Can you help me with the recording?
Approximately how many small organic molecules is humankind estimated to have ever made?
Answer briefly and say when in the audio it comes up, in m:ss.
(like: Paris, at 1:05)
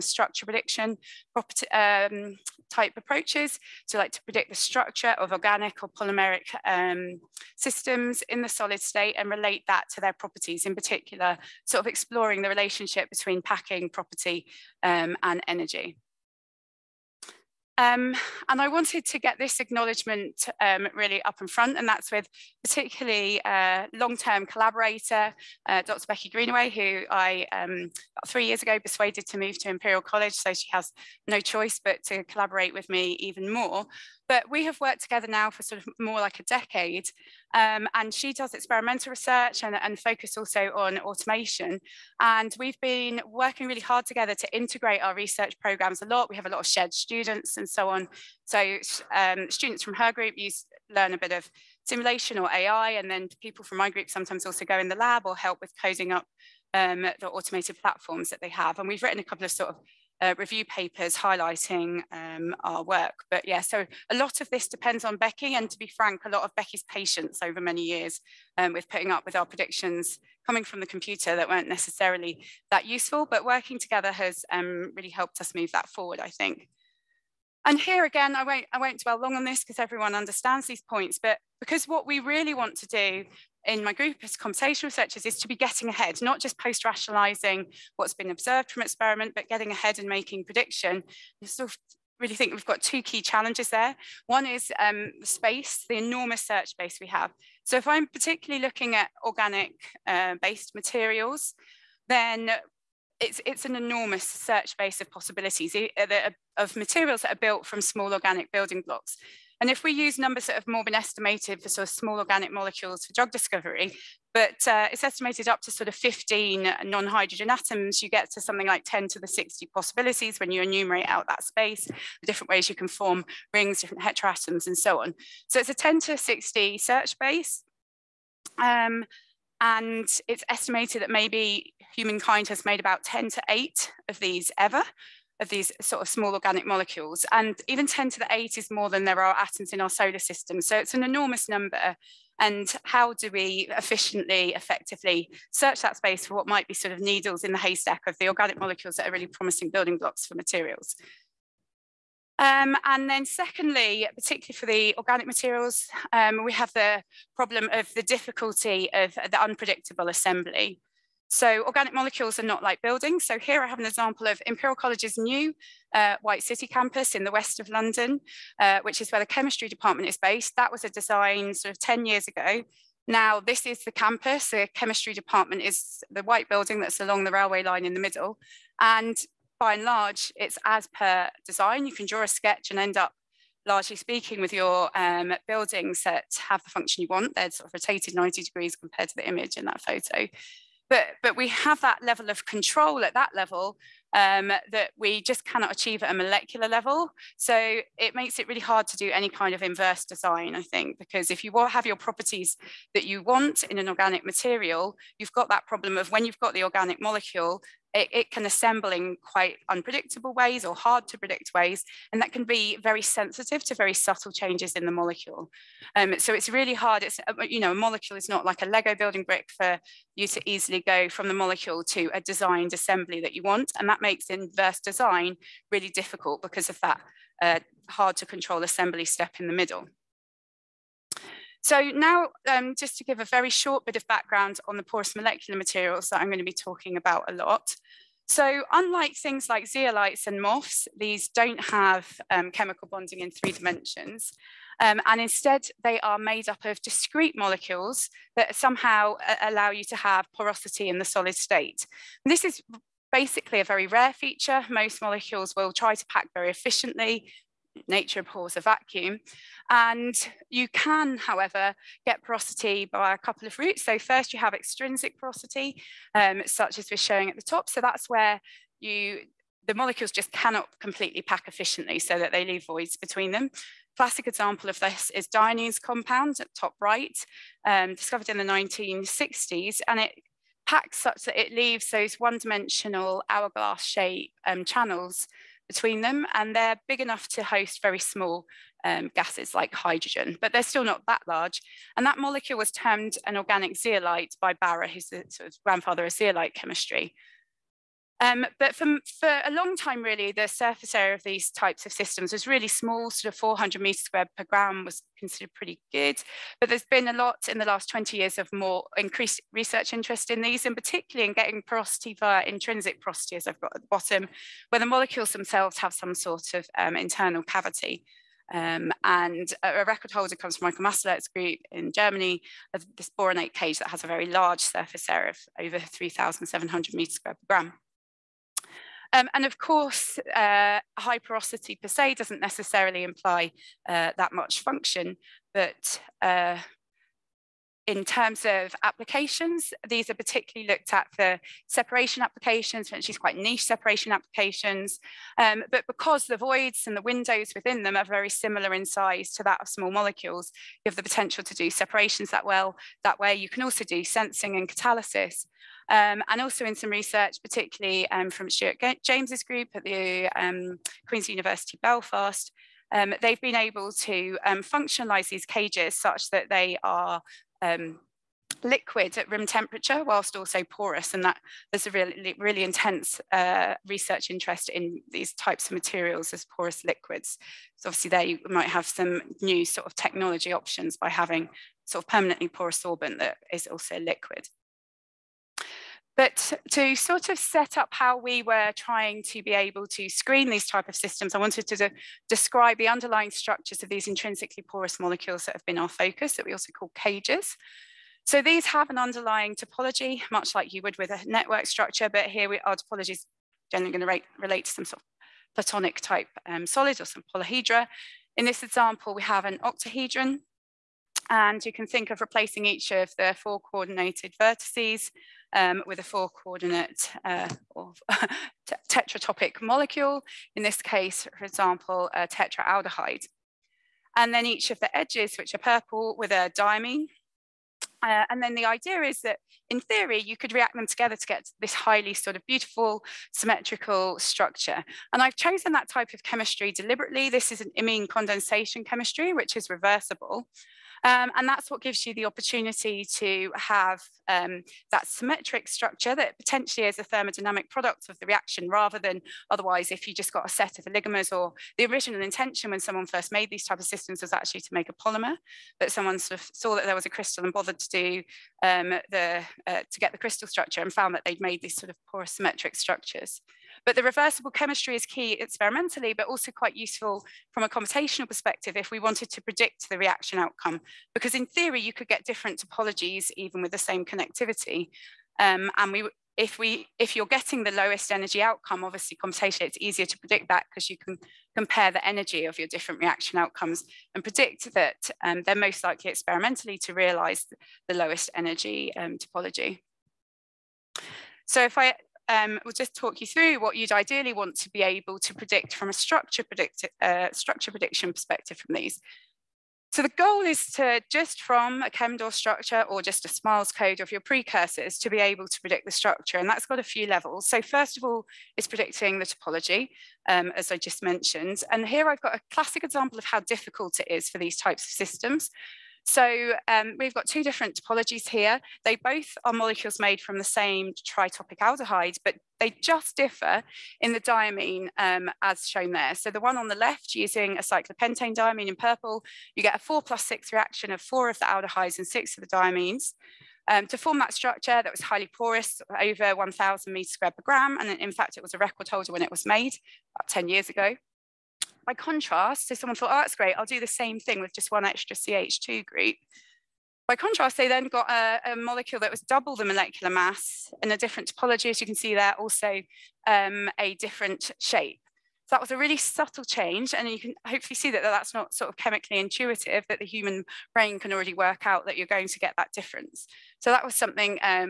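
10^8, at 2:13.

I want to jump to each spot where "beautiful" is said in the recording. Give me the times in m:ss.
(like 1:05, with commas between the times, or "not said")
7:12.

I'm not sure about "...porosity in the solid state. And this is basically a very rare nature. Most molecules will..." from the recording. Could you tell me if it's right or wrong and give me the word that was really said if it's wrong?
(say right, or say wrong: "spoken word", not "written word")
wrong: "feature", not "nature".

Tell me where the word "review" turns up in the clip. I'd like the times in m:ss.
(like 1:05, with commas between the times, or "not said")
1:00.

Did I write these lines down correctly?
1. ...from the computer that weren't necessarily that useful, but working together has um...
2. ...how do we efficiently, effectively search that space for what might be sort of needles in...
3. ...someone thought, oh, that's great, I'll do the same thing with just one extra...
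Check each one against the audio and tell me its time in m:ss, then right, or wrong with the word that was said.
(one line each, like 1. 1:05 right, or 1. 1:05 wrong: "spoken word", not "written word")
1. 1:10 right
2. 2:22 right
3. 9:02 right.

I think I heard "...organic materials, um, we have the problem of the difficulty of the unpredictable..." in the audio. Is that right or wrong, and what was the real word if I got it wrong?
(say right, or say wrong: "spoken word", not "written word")
right.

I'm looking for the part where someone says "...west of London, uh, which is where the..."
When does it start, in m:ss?
2:47.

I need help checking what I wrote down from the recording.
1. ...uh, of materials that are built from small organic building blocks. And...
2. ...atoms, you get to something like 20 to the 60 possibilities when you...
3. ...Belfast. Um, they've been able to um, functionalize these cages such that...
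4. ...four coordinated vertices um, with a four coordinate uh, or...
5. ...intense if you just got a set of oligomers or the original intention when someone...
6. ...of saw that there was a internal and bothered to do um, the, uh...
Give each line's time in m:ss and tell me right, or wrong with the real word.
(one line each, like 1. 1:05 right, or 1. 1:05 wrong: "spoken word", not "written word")
1. 1:45 right
2. 1:57 wrong: "10", not "20"
3. 6:01 right
4. 6:53 right
5. 7:29 wrong: "otherwise", not "intense"
6. 7:36 wrong: "crystal", not "internal".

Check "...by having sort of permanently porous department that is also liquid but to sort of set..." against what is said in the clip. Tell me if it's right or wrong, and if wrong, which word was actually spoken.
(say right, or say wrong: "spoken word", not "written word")
wrong: "sorbent", not "department".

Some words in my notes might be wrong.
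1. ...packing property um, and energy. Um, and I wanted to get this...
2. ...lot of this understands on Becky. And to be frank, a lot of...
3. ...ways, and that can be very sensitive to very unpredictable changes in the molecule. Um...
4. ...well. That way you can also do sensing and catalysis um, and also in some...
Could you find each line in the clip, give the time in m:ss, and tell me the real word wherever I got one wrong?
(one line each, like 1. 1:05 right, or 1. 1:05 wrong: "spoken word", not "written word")
1. 0:13 right
2. 1:04 wrong: "depends", not "understands"
3. 3:31 wrong: "subtle", not "unpredictable"
4. 5:52 right.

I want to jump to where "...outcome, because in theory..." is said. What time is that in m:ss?
7:50.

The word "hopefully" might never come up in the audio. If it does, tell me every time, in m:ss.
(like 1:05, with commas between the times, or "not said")
9:17.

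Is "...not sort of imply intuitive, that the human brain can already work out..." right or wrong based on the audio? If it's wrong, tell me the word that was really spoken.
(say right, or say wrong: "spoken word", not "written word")
wrong: "chemically", not "imply".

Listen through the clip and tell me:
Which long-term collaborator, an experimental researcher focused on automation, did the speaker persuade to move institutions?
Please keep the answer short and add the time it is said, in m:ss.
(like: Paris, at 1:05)
Becky Greenaway, at 0:25.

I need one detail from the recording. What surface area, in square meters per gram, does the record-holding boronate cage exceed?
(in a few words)
3,700.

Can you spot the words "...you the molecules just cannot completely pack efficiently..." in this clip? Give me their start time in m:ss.
4:28.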